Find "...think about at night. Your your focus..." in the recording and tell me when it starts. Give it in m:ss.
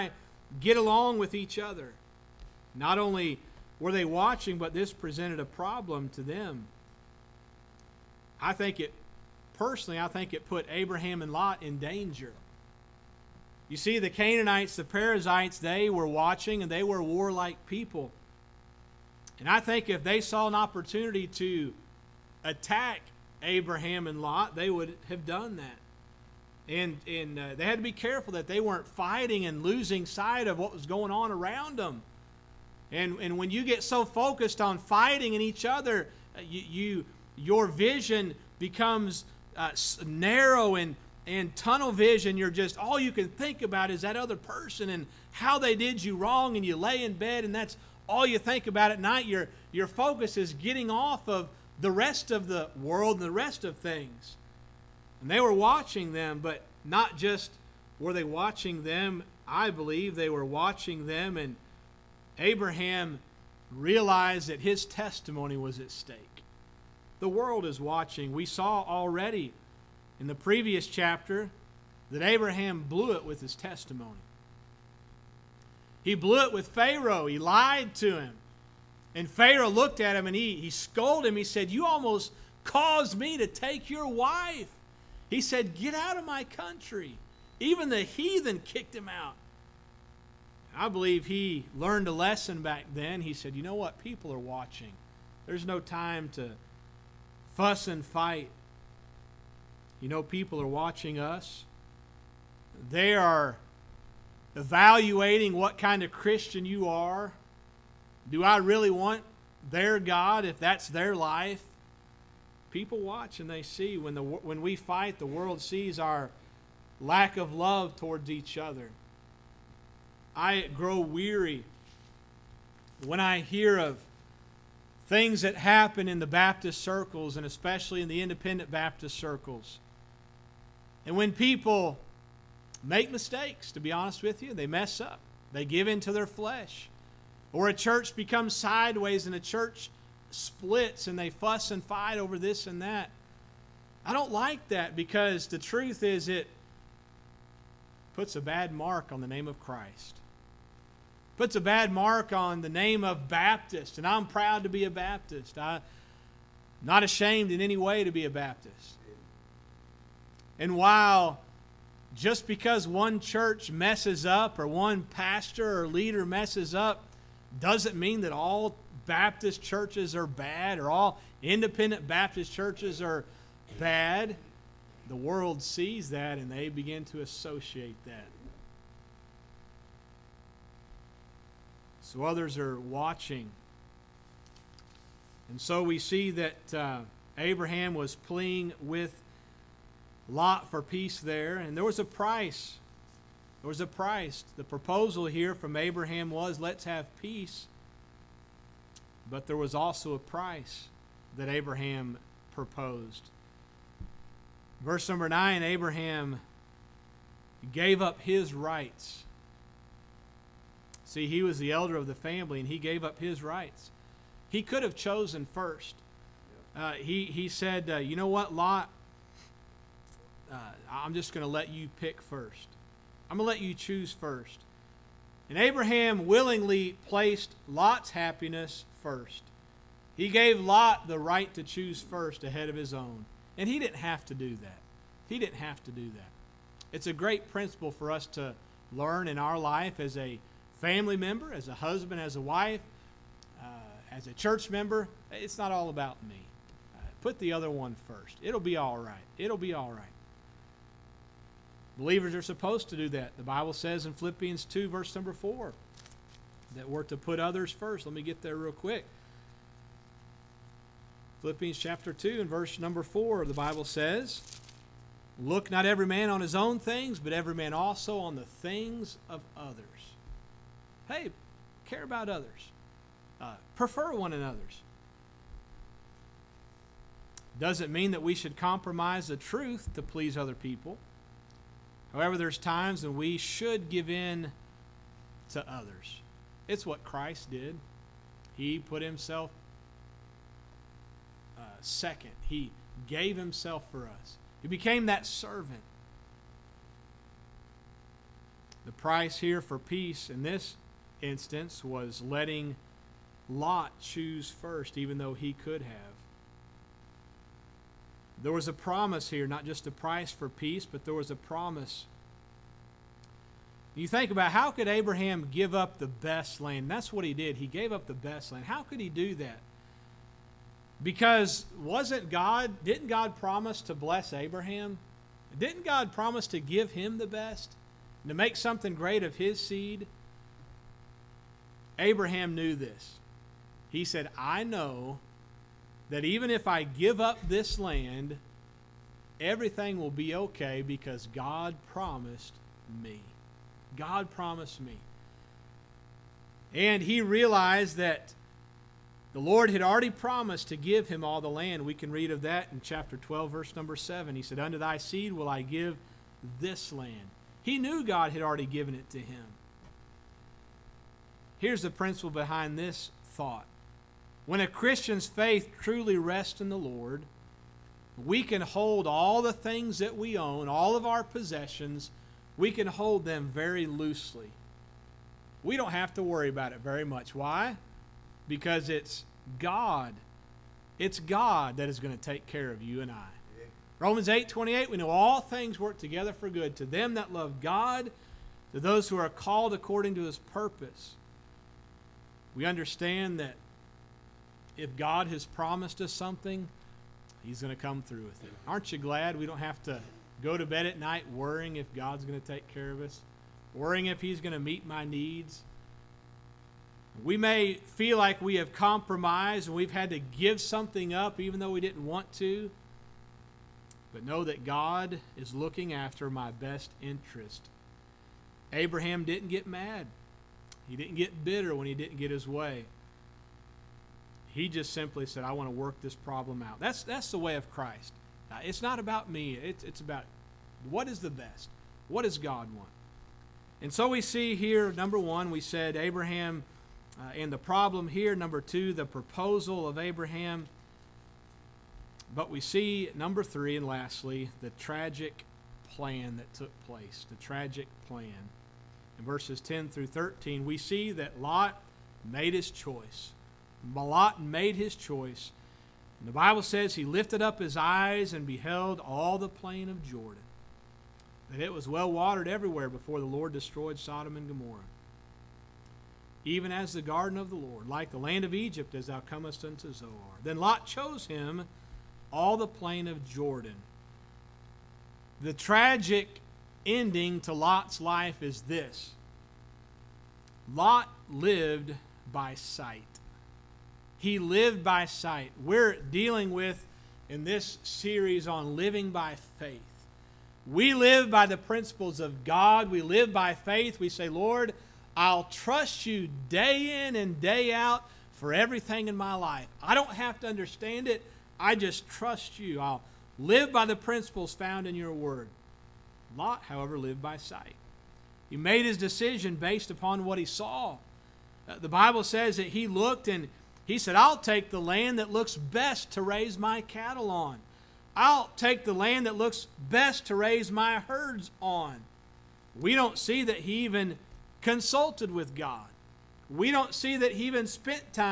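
0:48.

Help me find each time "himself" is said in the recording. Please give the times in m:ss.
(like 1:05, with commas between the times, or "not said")
4:49, 4:53.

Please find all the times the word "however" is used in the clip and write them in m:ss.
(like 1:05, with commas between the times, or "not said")
4:42, 8:26.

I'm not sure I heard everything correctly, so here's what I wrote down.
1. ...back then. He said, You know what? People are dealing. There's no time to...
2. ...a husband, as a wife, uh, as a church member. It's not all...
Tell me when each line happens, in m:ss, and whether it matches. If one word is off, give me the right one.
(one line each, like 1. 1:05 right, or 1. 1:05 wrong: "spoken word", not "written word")
1. 1:32 wrong: "watching", not "dealing"
2. 4:01 right.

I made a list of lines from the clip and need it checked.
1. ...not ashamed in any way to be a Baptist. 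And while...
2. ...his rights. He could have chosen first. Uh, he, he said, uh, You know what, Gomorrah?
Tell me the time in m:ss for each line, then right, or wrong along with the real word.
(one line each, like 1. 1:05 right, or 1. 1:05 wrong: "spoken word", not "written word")
1. 2:36 right
2. 3:33 wrong: "Lot", not "Gomorrah".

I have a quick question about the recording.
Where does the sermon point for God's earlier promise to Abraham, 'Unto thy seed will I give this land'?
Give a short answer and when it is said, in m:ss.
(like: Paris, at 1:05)
Chapter 12, verse 7, at 5:52.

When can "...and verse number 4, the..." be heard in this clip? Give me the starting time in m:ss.
4:22.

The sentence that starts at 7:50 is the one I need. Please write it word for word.
Then Lot chose him all the plain of Jordan.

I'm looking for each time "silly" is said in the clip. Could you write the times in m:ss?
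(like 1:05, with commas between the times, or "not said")
not said.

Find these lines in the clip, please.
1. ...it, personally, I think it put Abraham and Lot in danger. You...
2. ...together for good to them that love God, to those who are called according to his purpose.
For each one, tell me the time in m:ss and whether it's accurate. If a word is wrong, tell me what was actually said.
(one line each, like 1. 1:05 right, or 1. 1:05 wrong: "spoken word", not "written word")
1. 0:08 right
2. 6:25 right.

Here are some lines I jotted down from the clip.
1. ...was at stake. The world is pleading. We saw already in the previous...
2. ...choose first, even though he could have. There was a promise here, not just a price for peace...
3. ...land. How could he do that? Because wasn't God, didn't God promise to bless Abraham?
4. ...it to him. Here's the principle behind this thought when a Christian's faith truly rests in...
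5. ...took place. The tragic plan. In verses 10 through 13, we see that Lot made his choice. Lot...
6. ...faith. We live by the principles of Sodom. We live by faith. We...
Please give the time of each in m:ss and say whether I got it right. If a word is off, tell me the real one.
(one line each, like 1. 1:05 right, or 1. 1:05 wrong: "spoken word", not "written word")
1. 1:05 wrong: "watching", not "pleading"
2. 5:03 right
3. 5:18 right
4. 5:58 right
5. 7:26 right
6. 8:09 wrong: "God", not "Sodom".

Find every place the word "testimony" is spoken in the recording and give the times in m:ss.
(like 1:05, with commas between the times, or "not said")
1:04, 1:13.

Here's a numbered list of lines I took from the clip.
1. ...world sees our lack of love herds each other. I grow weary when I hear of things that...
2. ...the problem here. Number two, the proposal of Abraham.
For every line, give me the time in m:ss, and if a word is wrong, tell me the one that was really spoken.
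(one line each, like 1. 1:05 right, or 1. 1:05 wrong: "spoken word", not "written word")
1. 1:55 wrong: "towards", not "herds"
2. 7:17 right.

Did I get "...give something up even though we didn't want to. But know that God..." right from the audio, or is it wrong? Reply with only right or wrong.
right.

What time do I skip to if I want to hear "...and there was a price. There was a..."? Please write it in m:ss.
3:11.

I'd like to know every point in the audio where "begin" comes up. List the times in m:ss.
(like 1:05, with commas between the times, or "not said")
2:56.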